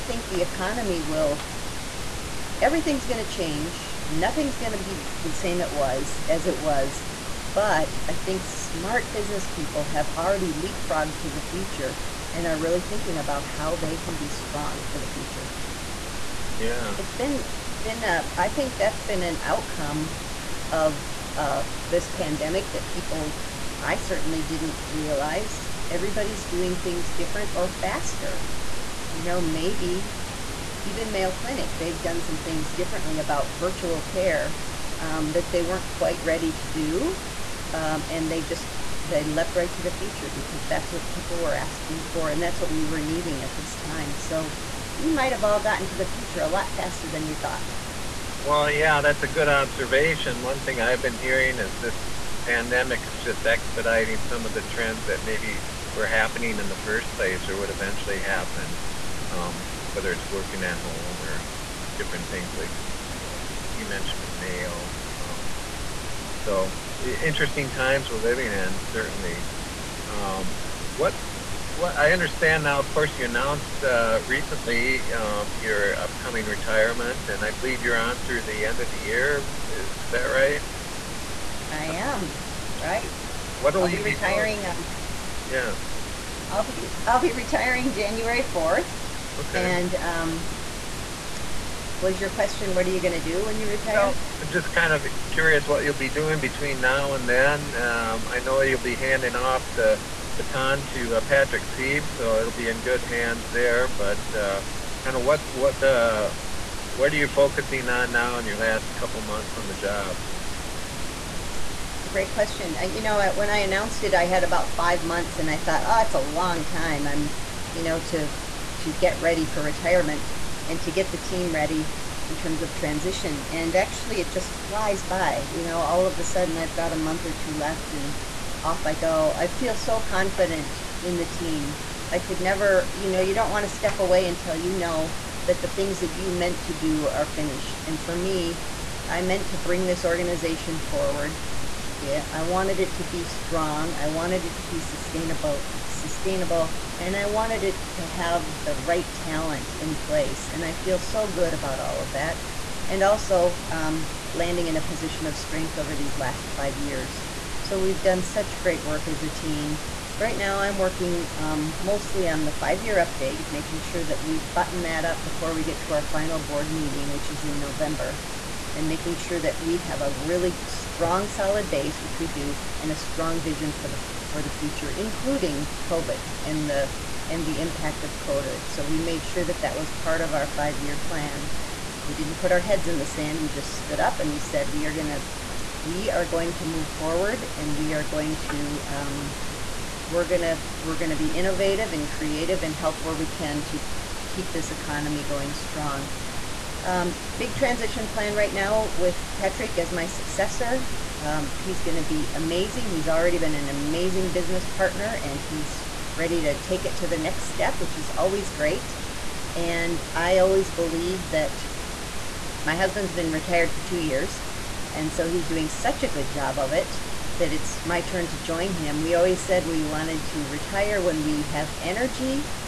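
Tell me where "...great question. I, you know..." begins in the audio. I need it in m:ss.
1:52.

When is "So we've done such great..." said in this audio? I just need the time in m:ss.
2:37.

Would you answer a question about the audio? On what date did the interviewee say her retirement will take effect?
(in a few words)
January 4.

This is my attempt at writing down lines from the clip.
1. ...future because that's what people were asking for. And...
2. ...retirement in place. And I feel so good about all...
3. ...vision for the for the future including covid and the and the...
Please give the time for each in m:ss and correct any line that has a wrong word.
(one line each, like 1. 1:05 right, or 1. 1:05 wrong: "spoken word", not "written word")
1. 0:39 right
2. 2:29 wrong: "talent", not "retirement"
3. 2:53 right.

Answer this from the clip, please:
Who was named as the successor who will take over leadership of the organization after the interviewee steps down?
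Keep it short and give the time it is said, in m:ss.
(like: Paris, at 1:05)
Patrick Seeb, at 1:41.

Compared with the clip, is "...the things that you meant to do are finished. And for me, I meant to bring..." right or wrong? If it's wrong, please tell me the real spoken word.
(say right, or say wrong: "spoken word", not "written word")
right.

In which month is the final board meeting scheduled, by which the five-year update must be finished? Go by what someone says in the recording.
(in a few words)
November.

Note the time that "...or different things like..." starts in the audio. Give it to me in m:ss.
1:01.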